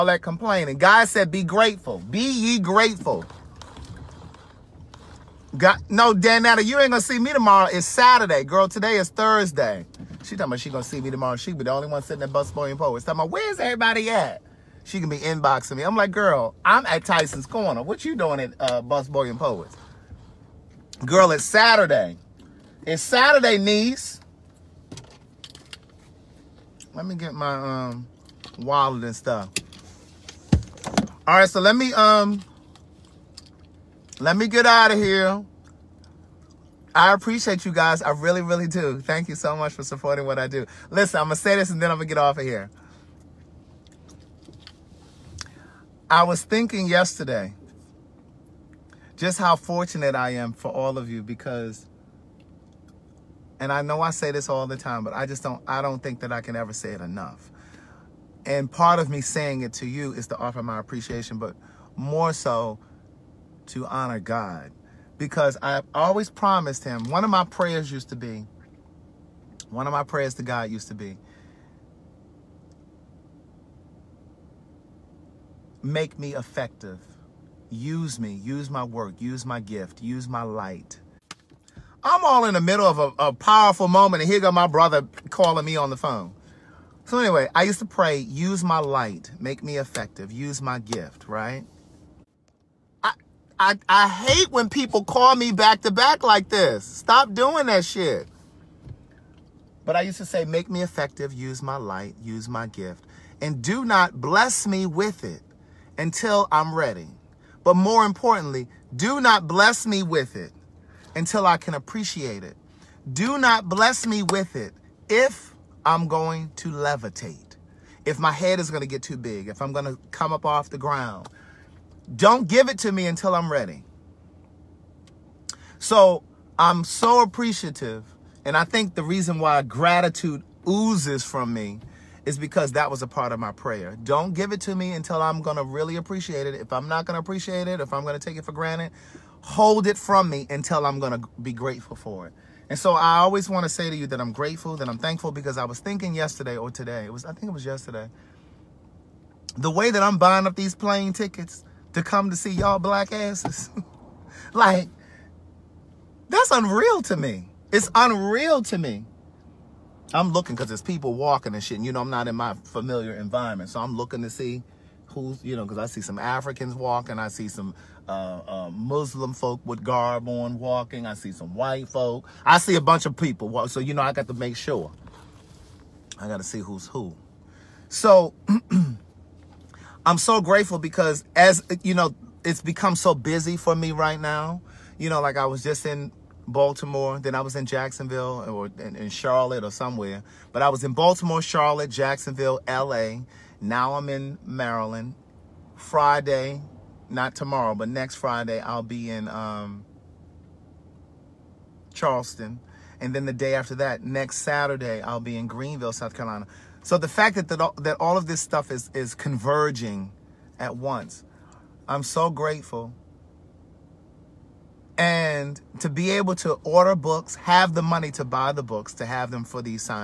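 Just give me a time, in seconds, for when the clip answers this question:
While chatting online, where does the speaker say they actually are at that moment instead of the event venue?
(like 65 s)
17 s.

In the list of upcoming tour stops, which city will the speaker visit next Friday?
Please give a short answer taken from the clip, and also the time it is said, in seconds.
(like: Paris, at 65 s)
Charleston, at 201 s.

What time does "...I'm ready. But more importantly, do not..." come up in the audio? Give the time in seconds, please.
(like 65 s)
106 s.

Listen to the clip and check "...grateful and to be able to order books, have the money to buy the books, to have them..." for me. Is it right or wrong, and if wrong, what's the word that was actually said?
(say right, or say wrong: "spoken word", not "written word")
right.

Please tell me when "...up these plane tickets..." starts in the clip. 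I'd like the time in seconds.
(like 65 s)
150 s.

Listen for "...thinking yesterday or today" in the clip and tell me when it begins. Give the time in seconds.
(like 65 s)
145 s.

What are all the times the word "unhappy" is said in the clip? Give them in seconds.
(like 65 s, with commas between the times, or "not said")
not said.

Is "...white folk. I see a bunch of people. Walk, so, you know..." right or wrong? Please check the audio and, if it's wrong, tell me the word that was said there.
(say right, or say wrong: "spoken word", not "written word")
right.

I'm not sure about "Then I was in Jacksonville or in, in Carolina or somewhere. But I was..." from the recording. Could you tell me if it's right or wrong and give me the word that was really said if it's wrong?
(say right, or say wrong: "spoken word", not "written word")
wrong: "Charlotte", not "Carolina".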